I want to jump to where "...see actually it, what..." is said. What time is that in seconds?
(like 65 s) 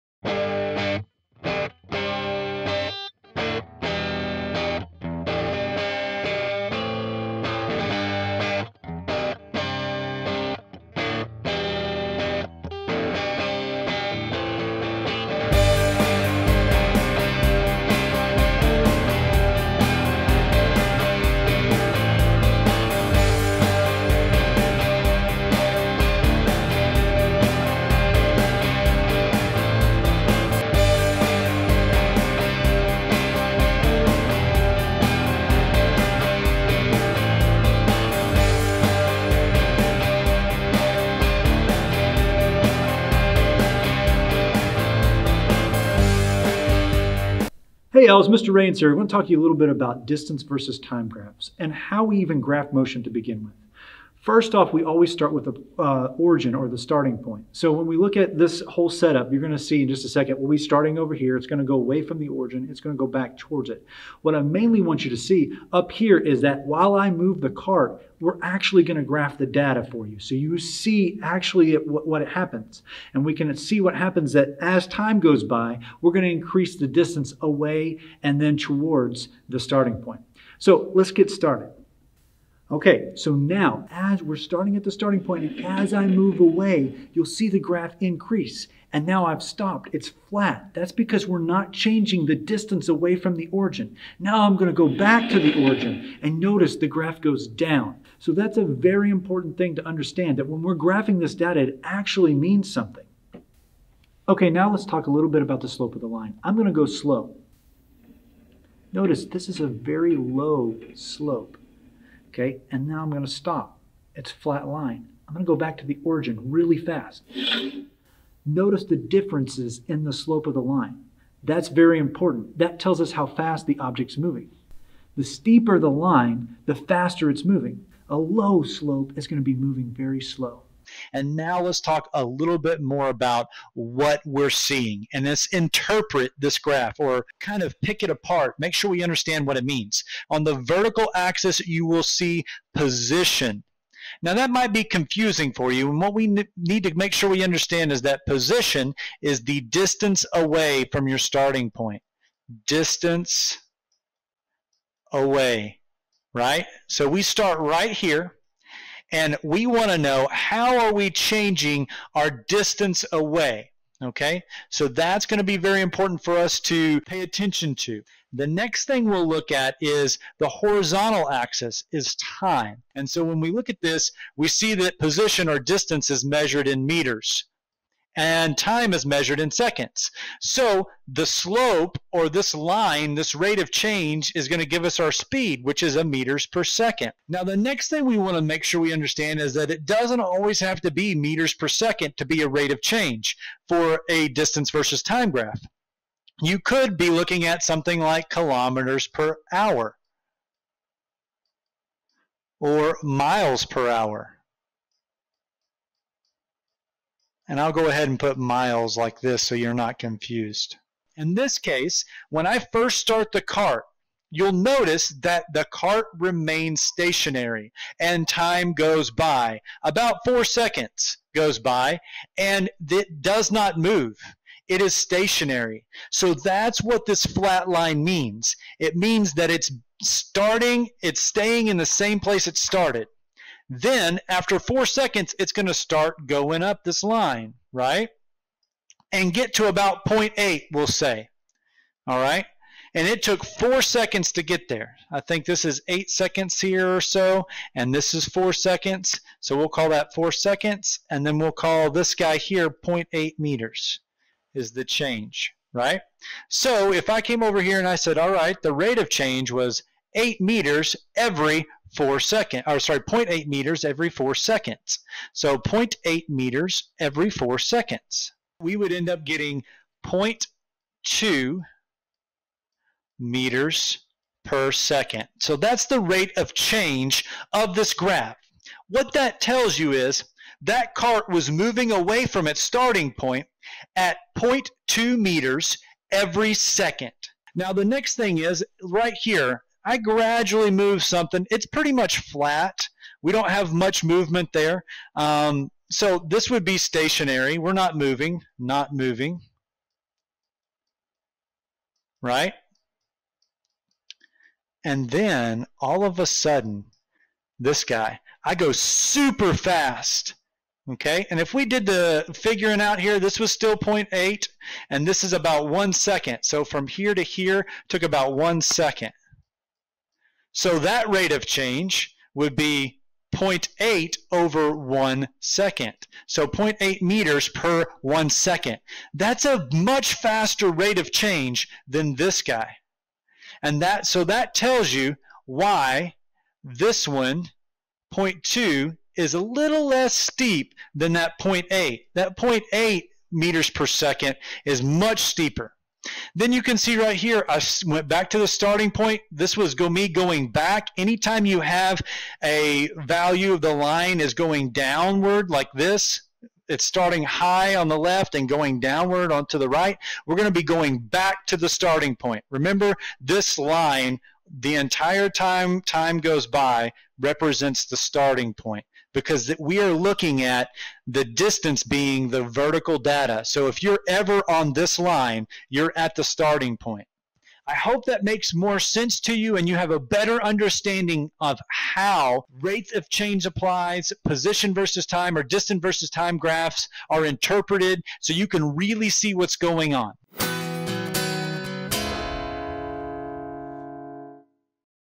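70 s.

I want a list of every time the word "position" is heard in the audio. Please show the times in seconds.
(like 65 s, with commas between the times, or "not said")
142 s, 148 s, 174 s, 384 s.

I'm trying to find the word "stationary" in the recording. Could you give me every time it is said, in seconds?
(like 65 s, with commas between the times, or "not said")
216 s, 224 s, 296 s.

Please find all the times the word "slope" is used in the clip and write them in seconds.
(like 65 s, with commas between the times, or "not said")
105 s, 110 s, 120 s, 128 s, 181 s.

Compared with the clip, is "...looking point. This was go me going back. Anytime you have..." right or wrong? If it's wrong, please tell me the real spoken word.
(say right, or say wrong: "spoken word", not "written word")
wrong: "starting", not "looking".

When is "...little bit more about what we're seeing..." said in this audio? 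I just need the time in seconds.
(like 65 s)
132 s.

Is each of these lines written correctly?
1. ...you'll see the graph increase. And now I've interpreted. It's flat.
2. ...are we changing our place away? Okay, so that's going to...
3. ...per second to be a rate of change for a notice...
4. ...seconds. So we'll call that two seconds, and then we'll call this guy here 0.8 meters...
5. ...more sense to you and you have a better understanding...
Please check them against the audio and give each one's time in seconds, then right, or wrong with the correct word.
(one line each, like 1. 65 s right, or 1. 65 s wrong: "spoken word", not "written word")
1. 87 s wrong: "stopped", not "interpreted"
2. 160 s wrong: "distance", not "place"
3. 191 s wrong: "distance", not "notice"
4. 248 s wrong: "four", not "two"
5. 378 s right.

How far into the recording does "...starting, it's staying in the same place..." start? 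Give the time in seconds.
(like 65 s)
230 s.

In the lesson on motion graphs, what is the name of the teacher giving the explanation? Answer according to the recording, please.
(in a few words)
Mr. Rains.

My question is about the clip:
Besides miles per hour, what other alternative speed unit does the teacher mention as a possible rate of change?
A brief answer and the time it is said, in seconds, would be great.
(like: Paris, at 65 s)
kilometers per hour, at 198 s.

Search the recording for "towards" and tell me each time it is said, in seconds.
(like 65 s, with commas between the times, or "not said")
63 s, 78 s.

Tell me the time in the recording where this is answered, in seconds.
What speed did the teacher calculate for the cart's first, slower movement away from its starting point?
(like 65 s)
270 s.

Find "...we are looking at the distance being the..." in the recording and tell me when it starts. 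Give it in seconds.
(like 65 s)
369 s.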